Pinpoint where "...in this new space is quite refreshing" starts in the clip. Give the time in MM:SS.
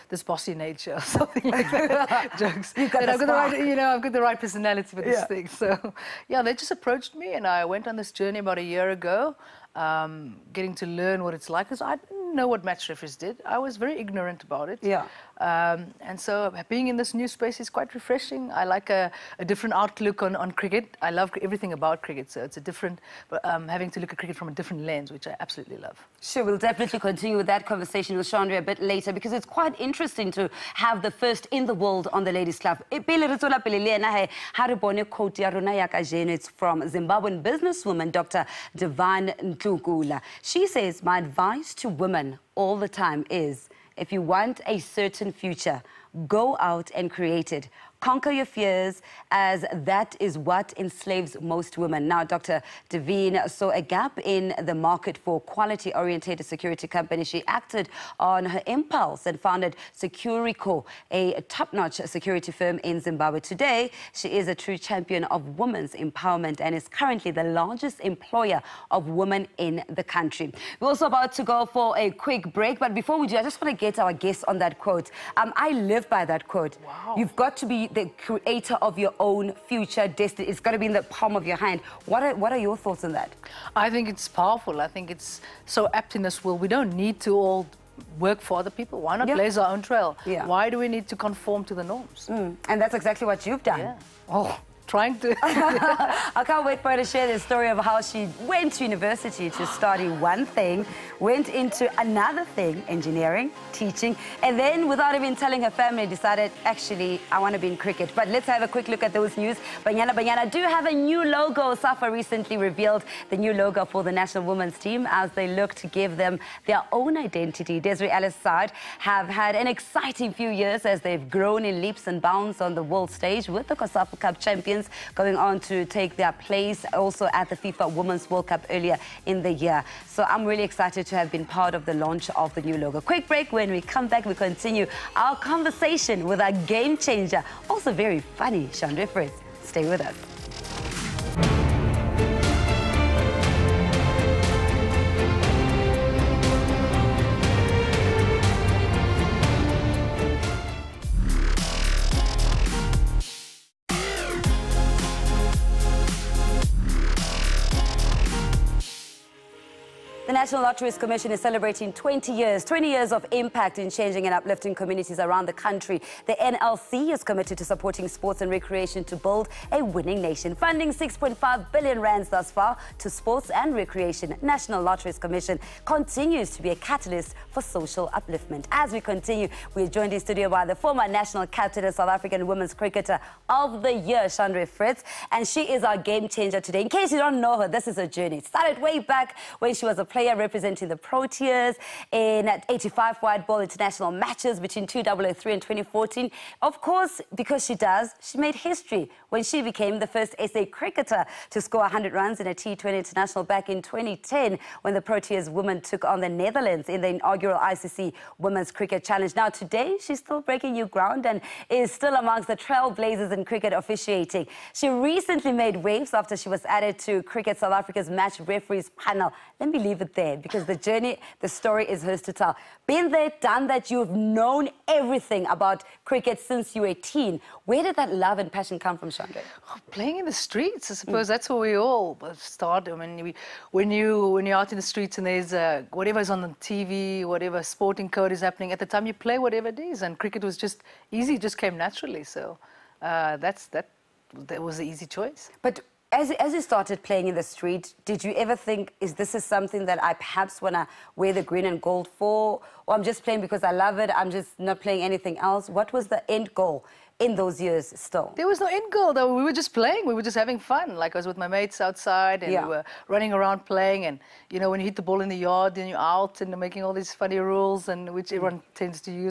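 00:16.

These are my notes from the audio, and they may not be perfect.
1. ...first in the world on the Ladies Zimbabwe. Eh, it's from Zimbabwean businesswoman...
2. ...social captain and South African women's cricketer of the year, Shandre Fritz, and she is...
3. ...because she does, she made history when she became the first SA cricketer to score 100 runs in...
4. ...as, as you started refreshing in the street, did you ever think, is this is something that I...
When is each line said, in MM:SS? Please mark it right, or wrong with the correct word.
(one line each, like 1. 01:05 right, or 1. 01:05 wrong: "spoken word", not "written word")
1. 00:31 wrong: "Club", not "Zimbabwe"
2. 03:01 wrong: "national", not "social"
3. 03:17 right
4. 04:06 wrong: "playing", not "refreshing".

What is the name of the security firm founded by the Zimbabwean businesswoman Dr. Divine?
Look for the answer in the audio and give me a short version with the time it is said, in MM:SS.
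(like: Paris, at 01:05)
Securico, at 00:59.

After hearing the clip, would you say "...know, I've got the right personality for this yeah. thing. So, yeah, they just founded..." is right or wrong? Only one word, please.
wrong.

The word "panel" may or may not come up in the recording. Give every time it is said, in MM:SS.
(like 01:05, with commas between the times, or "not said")
03:38.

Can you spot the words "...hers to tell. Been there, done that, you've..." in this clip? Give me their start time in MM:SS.
03:42.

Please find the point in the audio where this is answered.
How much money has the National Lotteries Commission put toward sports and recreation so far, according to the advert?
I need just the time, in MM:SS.
02:50.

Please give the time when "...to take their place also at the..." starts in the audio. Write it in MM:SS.
02:05.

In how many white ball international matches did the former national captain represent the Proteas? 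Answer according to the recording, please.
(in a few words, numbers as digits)
85.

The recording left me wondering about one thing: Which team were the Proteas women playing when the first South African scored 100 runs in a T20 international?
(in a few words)
Netherlands.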